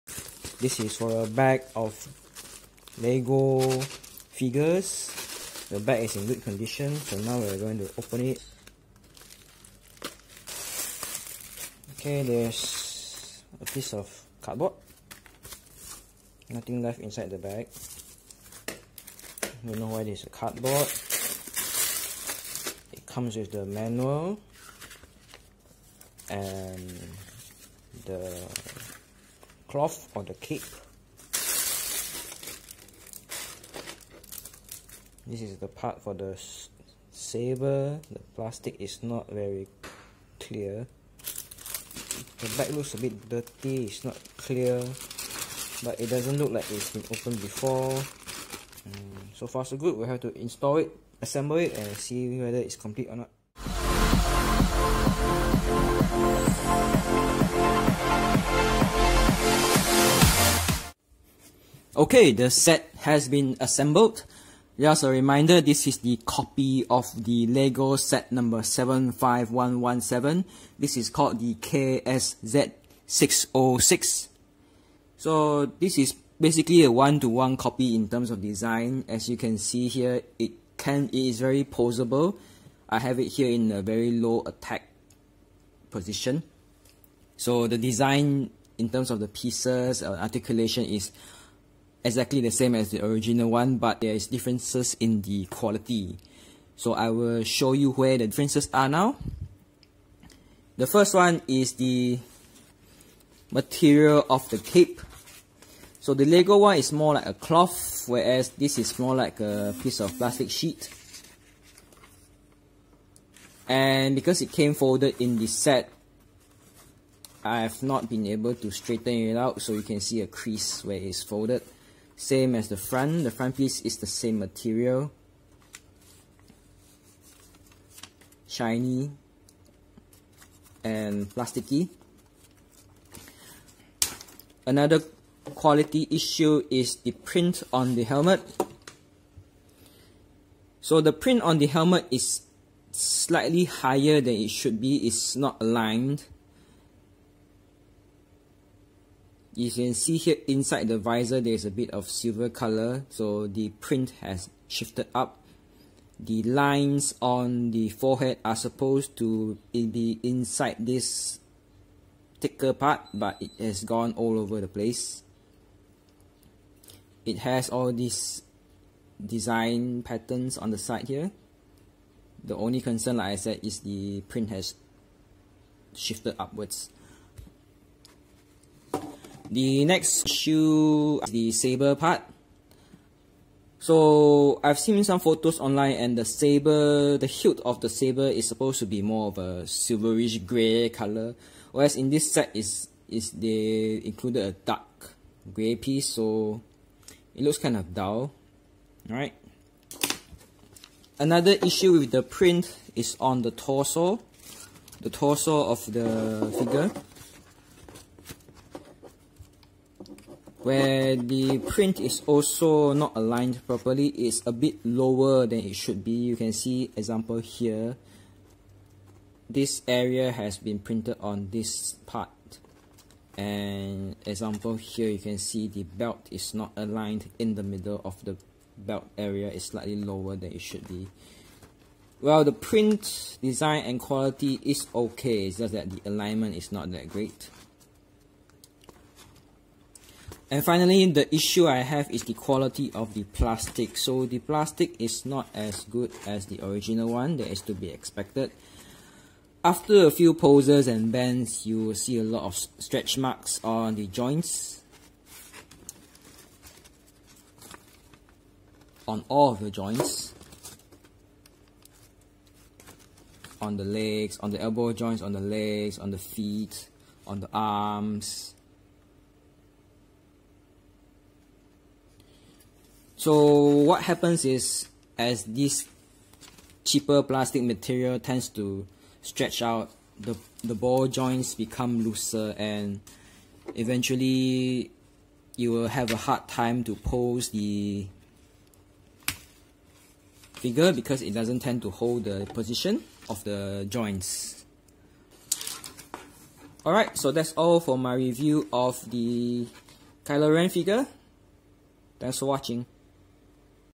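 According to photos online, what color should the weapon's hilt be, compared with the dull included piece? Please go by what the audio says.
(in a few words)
Silverish grey.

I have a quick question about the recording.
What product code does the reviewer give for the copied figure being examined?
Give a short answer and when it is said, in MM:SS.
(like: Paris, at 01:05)
KSZ606, at 01:11.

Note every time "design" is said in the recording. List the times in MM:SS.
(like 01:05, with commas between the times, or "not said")
01:18, 01:27, 02:49, 03:53.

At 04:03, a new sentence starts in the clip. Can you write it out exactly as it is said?
So the plastic is not as good as the original one, that is to be expected.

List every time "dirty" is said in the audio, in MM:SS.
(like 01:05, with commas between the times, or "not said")
00:43.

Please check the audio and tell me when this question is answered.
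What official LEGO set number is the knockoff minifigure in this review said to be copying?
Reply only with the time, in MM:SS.
01:08.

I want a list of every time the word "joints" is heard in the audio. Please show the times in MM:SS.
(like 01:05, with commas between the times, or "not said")
04:14, 04:19, 04:24, 04:41, 04:53.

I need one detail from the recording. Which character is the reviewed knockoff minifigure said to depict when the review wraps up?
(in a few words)
Kylo Ren.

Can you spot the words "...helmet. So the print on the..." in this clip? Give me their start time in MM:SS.
02:18.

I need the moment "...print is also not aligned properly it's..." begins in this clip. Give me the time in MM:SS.
03:31.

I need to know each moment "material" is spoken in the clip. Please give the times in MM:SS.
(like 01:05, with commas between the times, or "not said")
01:43, 02:04, 04:37.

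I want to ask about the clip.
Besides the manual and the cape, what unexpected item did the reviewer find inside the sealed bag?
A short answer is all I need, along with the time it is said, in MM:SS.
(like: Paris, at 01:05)
A piece of cardboard, at 00:13.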